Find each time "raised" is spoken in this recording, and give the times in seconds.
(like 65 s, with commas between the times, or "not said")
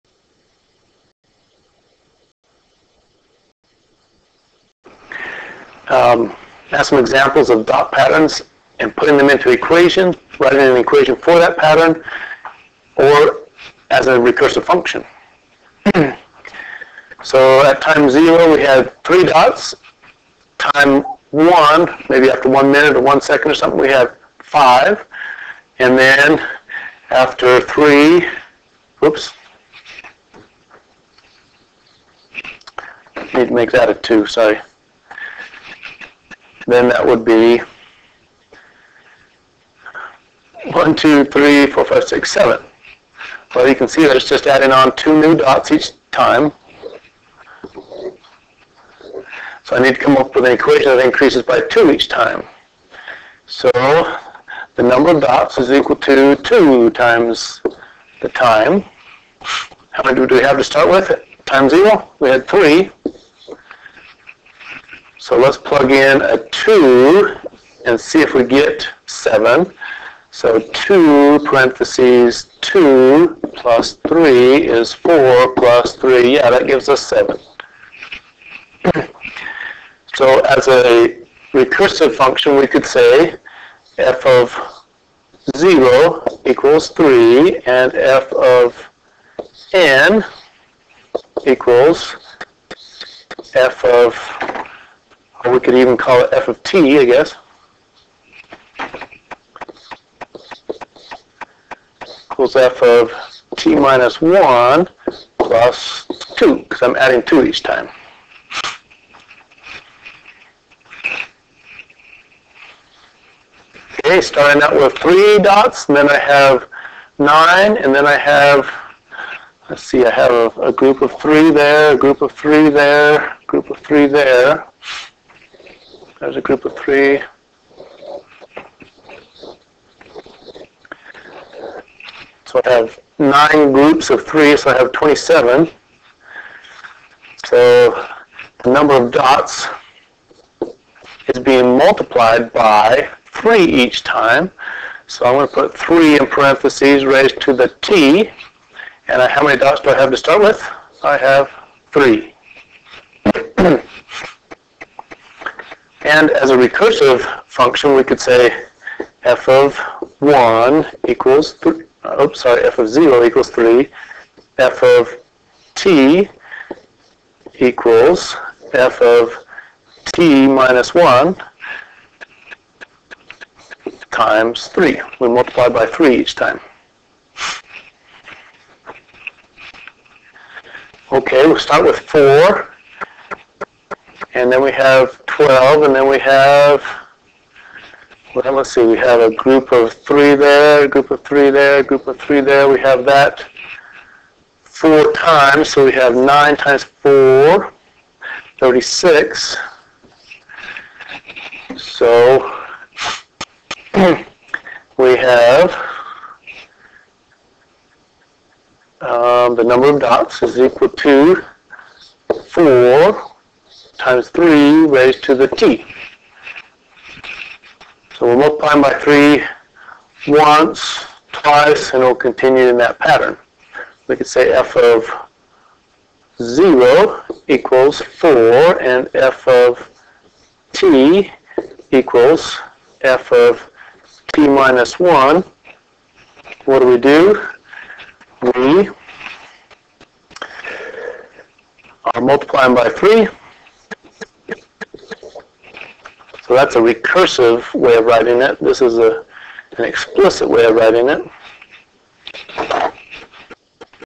147 s, 214 s.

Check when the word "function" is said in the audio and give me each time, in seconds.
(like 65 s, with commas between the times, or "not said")
14 s, 82 s, 157 s.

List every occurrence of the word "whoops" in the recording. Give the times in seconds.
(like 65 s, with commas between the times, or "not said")
28 s.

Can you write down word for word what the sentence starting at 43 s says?
Well, you can see that it's just adding on two new dots each time.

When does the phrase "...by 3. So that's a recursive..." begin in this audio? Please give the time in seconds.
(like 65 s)
242 s.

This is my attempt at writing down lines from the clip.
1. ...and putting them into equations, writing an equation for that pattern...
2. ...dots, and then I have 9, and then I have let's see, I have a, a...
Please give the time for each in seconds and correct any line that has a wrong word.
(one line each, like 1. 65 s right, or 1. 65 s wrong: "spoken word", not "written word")
1. 8 s right
2. 115 s right.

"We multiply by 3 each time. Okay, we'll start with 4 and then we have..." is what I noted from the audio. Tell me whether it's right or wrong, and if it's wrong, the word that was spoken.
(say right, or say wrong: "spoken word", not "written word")
right.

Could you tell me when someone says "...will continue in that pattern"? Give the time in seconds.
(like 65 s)
222 s.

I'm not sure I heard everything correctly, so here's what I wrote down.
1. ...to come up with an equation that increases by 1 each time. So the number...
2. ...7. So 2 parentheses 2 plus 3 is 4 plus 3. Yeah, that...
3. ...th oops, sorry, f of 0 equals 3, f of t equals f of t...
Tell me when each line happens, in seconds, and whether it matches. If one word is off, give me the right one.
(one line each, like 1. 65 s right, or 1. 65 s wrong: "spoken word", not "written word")
1. 49 s wrong: "2", not "1"
2. 69 s right
3. 161 s right.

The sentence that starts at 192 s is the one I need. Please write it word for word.
We have that four times, so we have 9 times 4, 36.